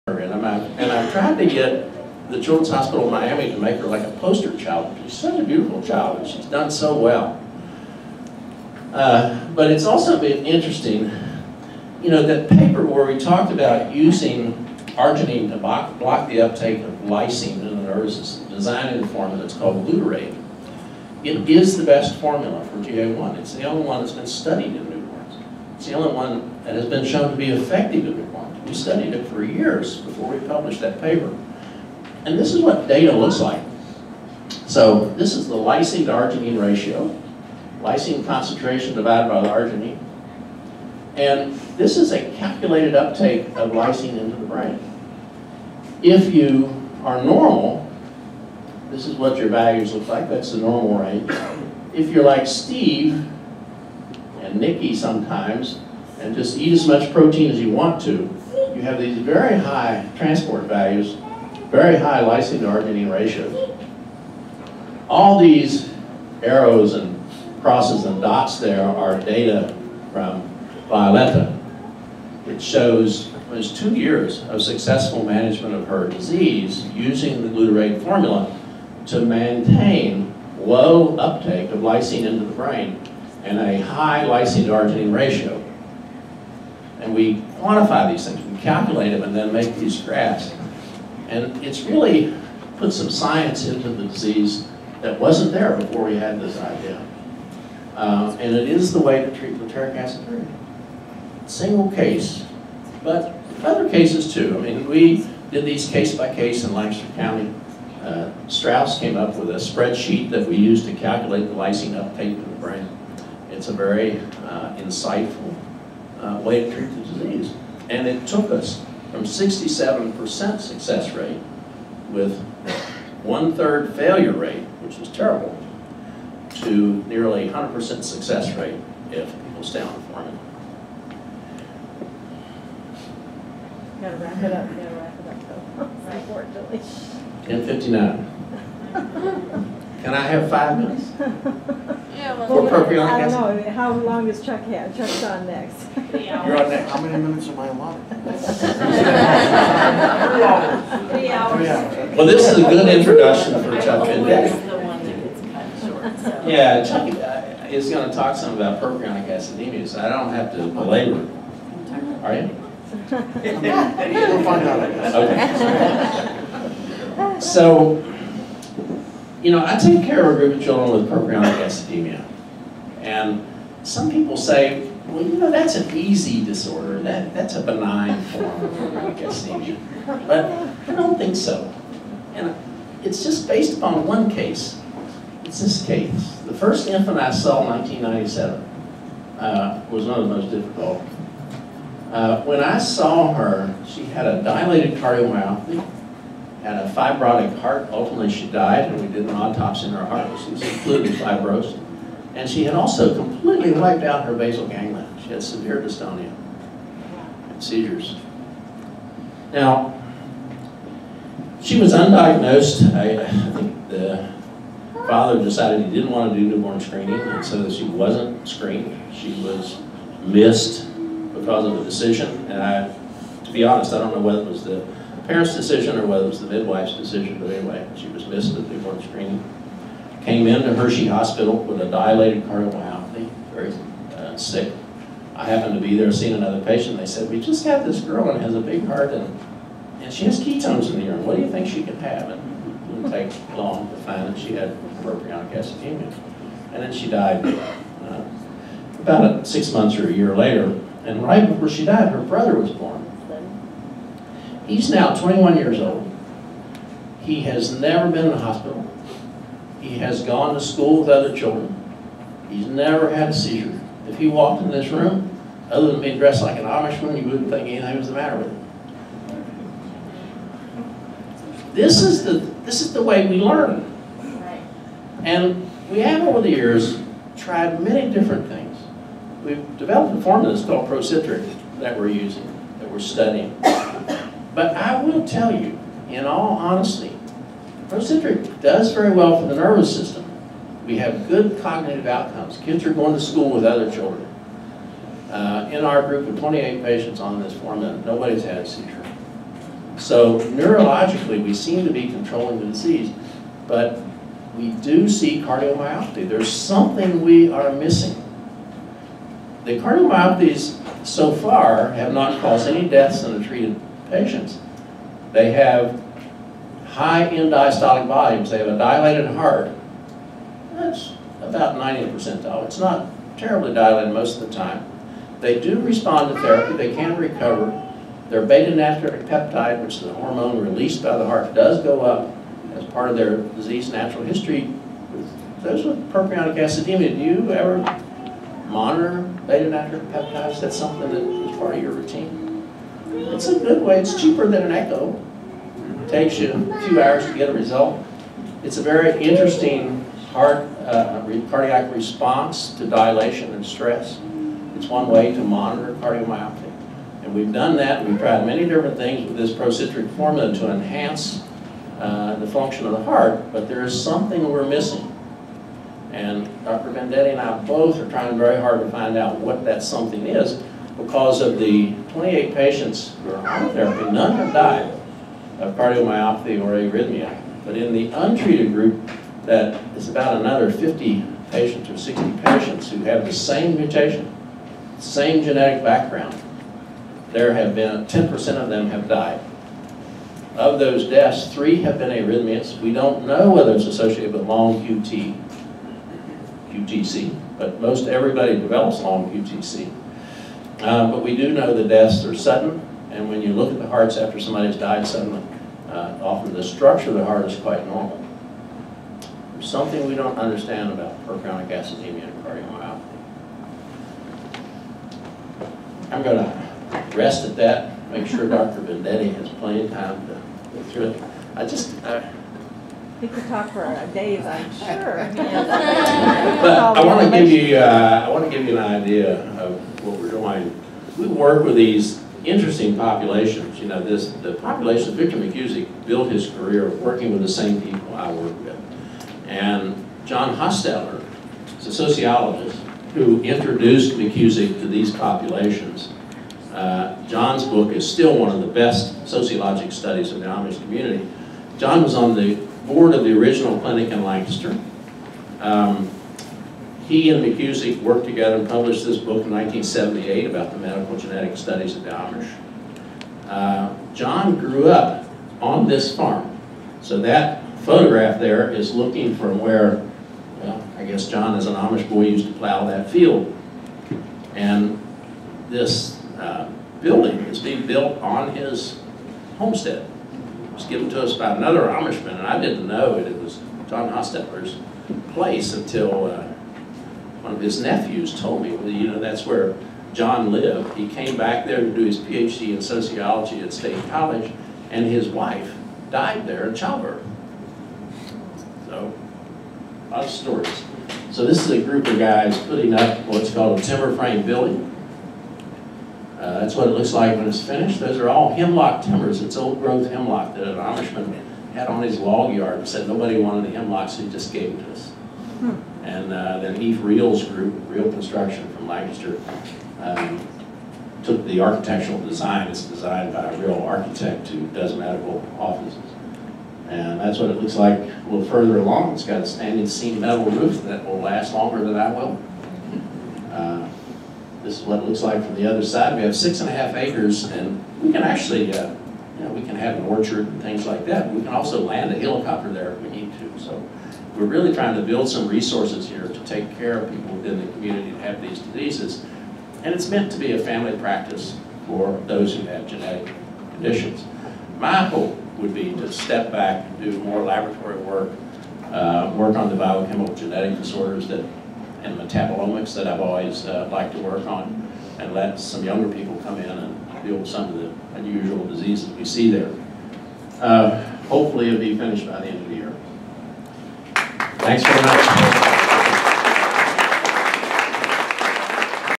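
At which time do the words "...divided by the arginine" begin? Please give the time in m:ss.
0:38.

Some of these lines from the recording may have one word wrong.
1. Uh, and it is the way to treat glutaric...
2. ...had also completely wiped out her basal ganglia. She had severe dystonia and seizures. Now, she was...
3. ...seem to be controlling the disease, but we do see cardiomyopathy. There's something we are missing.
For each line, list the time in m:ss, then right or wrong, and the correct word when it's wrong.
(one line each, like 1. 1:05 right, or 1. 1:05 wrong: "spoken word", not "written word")
1. 1:37 right
2. 3:22 right
3. 5:01 right.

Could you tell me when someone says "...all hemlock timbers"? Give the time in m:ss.
8:28.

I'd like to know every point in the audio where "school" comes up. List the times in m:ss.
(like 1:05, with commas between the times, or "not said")
4:20, 4:53.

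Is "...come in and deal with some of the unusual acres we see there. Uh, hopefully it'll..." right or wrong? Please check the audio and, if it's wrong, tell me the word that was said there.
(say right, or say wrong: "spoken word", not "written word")
wrong: "diseases", not "acres".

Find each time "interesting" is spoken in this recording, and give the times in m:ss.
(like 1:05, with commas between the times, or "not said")
0:10, 5:49, 7:12.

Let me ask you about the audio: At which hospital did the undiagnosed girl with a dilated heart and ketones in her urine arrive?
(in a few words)
Hershey Hospital.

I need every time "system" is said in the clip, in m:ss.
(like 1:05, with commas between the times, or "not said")
0:18, 4:49.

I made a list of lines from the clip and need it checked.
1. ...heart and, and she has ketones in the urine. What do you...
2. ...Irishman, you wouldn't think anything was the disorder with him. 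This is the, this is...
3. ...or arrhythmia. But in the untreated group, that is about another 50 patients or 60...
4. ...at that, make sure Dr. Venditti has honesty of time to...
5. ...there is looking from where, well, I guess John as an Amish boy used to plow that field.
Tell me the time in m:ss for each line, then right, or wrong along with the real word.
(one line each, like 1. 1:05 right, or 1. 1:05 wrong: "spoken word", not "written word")
1. 3:58 right
2. 4:26 wrong: "matter", not "disorder"
3. 6:16 right
4. 6:57 wrong: "plenty", not "honesty"
5. 7:48 right.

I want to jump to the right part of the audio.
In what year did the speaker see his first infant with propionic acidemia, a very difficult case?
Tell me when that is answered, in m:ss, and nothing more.
3:07.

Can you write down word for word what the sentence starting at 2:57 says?
That, that's a benign form of acidemia.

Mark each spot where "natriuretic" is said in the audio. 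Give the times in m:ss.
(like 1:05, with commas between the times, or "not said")
5:28, 5:39.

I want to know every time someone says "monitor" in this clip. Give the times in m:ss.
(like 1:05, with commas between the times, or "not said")
5:38, 5:55.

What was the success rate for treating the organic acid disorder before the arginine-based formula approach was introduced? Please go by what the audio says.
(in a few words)
67%.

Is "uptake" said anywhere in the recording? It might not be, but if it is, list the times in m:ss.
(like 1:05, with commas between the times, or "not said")
0:16, 0:42, 1:21, 1:51.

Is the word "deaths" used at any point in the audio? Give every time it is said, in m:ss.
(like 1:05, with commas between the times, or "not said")
5:12, 6:31, 6:41.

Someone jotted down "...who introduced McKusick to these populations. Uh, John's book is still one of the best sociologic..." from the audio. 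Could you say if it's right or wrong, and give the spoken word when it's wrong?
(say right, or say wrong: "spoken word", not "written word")
right.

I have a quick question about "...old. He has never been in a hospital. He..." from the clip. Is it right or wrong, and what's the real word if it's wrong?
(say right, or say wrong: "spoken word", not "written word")
right.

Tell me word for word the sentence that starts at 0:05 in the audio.
She's such a beautiful child, and she's done so well.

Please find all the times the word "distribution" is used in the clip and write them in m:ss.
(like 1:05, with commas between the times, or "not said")
not said.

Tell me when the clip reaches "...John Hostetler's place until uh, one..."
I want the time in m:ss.
8:03.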